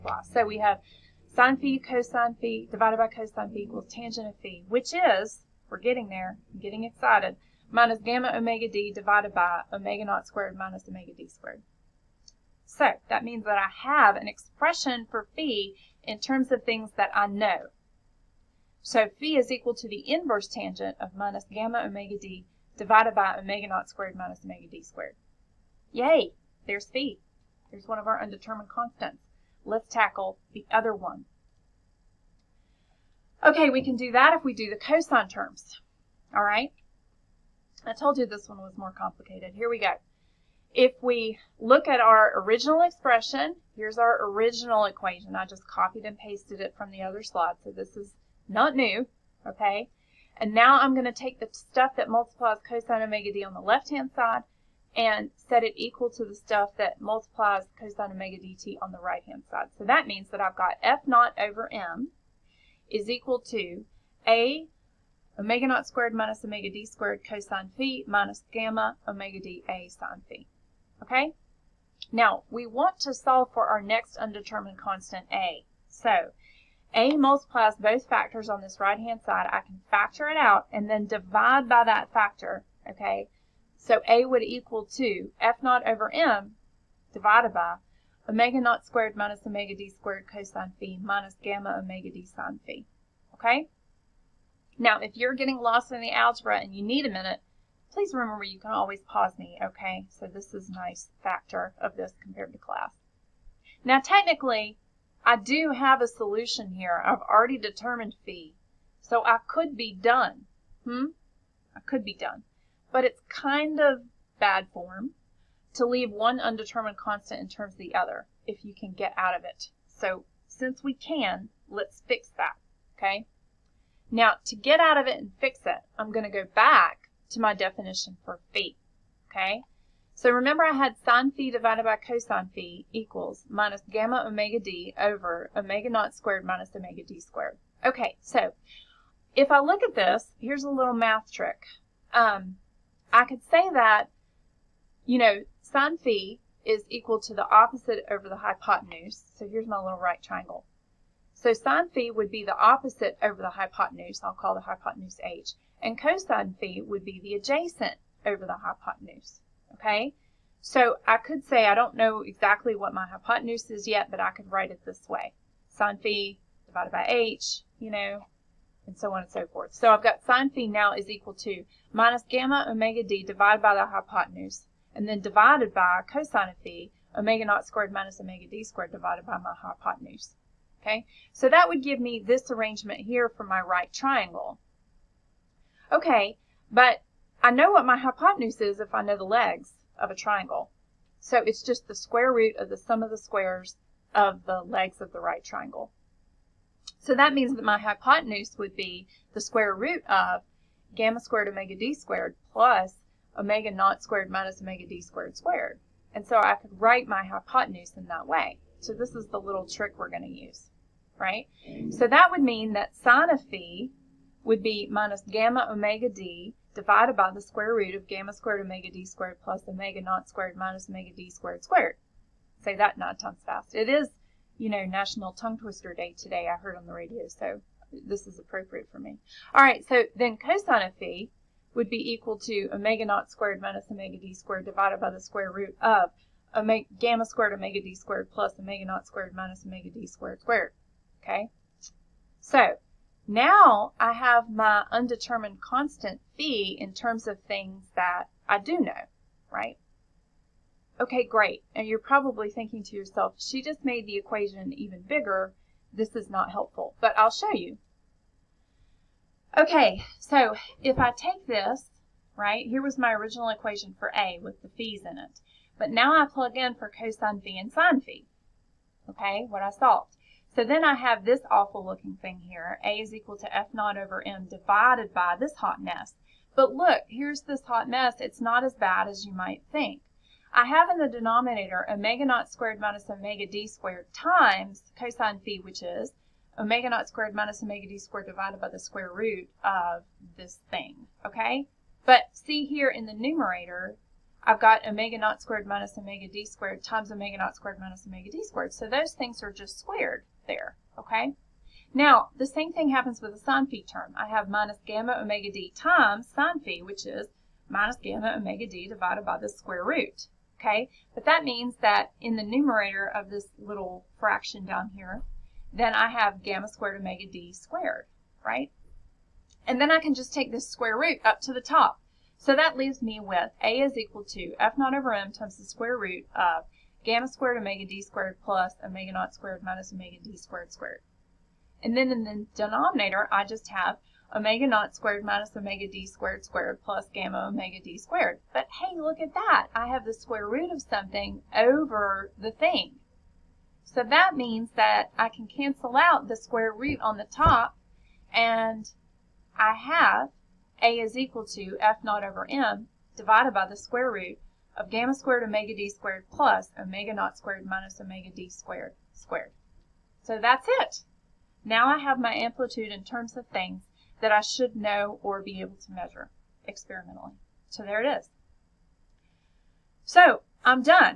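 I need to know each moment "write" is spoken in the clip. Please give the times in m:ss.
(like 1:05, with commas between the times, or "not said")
2:44, 3:26.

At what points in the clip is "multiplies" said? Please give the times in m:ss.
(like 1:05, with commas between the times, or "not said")
0:52, 0:56, 1:17.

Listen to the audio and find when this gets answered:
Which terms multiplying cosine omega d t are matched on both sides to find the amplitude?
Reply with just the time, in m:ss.
0:34.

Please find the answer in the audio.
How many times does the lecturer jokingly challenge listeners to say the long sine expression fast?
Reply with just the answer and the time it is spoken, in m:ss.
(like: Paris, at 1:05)
9, at 3:42.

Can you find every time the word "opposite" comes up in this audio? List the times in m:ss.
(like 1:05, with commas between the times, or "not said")
2:27, 2:32.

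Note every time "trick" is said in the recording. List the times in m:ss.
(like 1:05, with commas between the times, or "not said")
2:21, 3:29.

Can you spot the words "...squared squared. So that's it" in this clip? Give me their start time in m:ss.
5:58.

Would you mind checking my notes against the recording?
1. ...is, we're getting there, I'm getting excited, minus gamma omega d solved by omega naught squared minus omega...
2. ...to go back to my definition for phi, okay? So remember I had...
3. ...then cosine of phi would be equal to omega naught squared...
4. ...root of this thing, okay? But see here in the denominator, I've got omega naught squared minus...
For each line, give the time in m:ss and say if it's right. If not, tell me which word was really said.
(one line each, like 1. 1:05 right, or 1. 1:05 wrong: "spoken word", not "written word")
1. 0:04 wrong: "divided", not "solved"
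2. 2:06 right
3. 3:50 right
4. 4:49 wrong: "numerator", not "denominator".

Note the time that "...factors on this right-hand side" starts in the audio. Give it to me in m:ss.
1:18.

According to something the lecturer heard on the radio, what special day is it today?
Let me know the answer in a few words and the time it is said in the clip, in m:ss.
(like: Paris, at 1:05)
National Tongue Twister Day, at 3:44.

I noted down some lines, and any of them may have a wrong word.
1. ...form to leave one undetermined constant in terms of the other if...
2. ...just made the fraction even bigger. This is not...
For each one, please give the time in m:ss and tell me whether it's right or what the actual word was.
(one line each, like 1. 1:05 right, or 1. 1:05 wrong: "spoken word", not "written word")
1. 1:54 right
2. 4:13 wrong: "equation", not "fraction".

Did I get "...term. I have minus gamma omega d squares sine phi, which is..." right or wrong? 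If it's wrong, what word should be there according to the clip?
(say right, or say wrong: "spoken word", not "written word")
wrong: "times", not "squares".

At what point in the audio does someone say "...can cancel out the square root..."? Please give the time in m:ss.
5:45.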